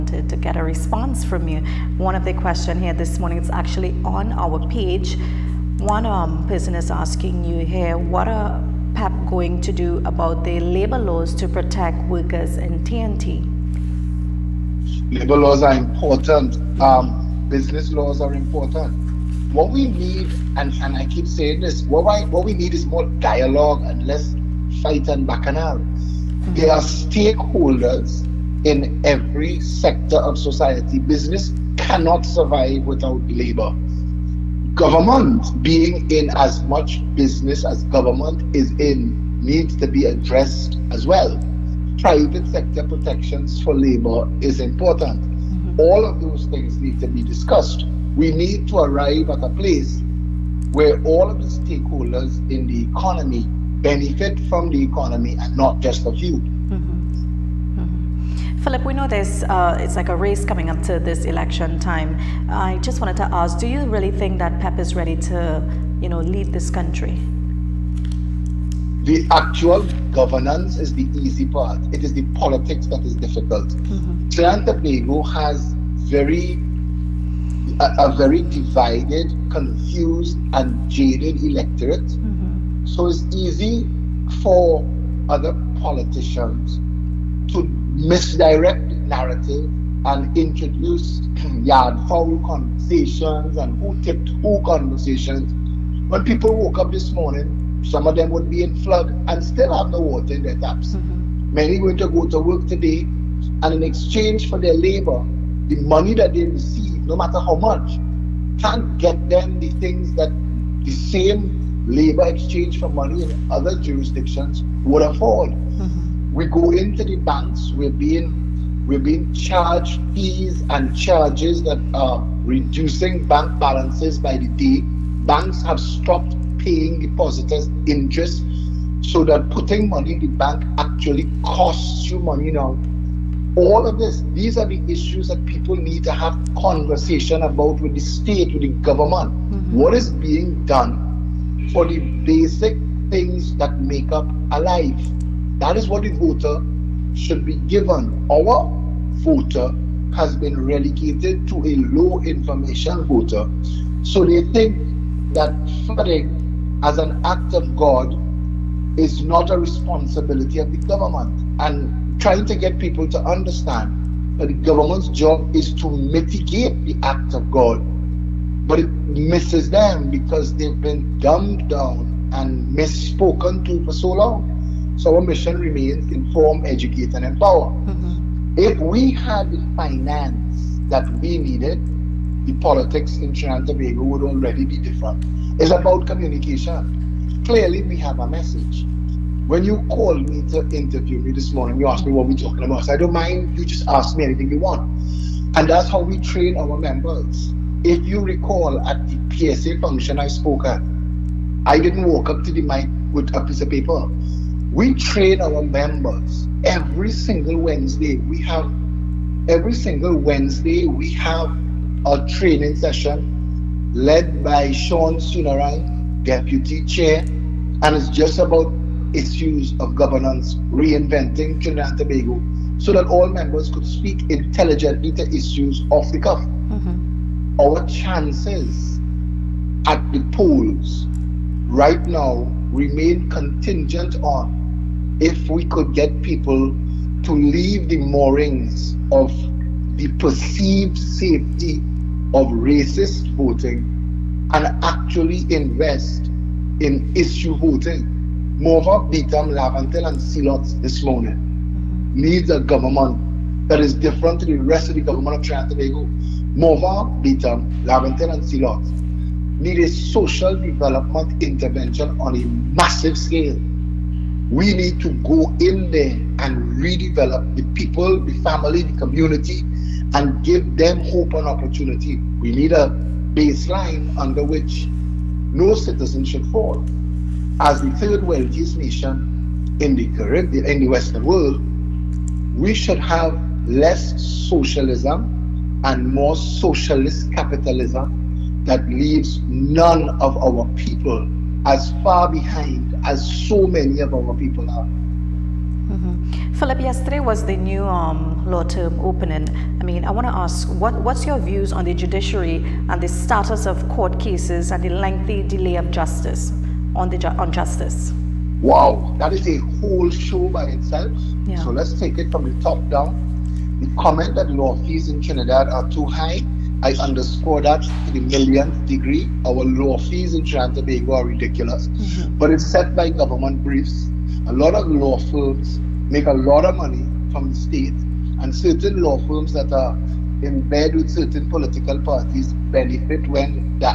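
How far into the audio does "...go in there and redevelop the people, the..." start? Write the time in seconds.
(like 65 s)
265 s.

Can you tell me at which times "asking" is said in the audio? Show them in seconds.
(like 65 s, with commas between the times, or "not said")
6 s.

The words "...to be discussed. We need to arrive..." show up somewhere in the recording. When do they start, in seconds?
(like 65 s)
46 s.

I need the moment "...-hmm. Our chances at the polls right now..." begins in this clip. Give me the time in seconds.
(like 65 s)
226 s.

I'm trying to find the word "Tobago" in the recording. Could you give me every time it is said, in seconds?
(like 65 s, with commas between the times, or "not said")
74 s, 183 s, 221 s, 255 s, 320 s.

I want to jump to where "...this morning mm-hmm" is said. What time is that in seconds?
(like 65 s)
250 s.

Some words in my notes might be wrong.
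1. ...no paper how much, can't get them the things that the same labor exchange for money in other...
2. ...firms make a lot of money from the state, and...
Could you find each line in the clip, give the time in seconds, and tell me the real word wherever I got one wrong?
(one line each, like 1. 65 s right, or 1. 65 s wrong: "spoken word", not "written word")
1. 107 s wrong: "matter", not "paper"
2. 325 s right.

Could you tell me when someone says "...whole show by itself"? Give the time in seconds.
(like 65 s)
309 s.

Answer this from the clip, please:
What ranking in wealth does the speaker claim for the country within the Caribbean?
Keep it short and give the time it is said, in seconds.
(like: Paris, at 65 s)
third wealthiest, at 277 s.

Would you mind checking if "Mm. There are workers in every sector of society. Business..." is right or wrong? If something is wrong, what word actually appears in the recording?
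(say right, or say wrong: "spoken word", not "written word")
wrong: "stakeholders", not "workers".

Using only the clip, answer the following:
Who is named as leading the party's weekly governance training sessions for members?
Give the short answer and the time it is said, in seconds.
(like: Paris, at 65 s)
Sean Sunaran, at 214 s.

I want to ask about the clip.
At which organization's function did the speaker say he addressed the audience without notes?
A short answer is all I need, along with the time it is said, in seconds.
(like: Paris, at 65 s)
PSA, at 199 s.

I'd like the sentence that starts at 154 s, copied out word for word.
So they think that flooding as an act of God is not a responsibility of the government.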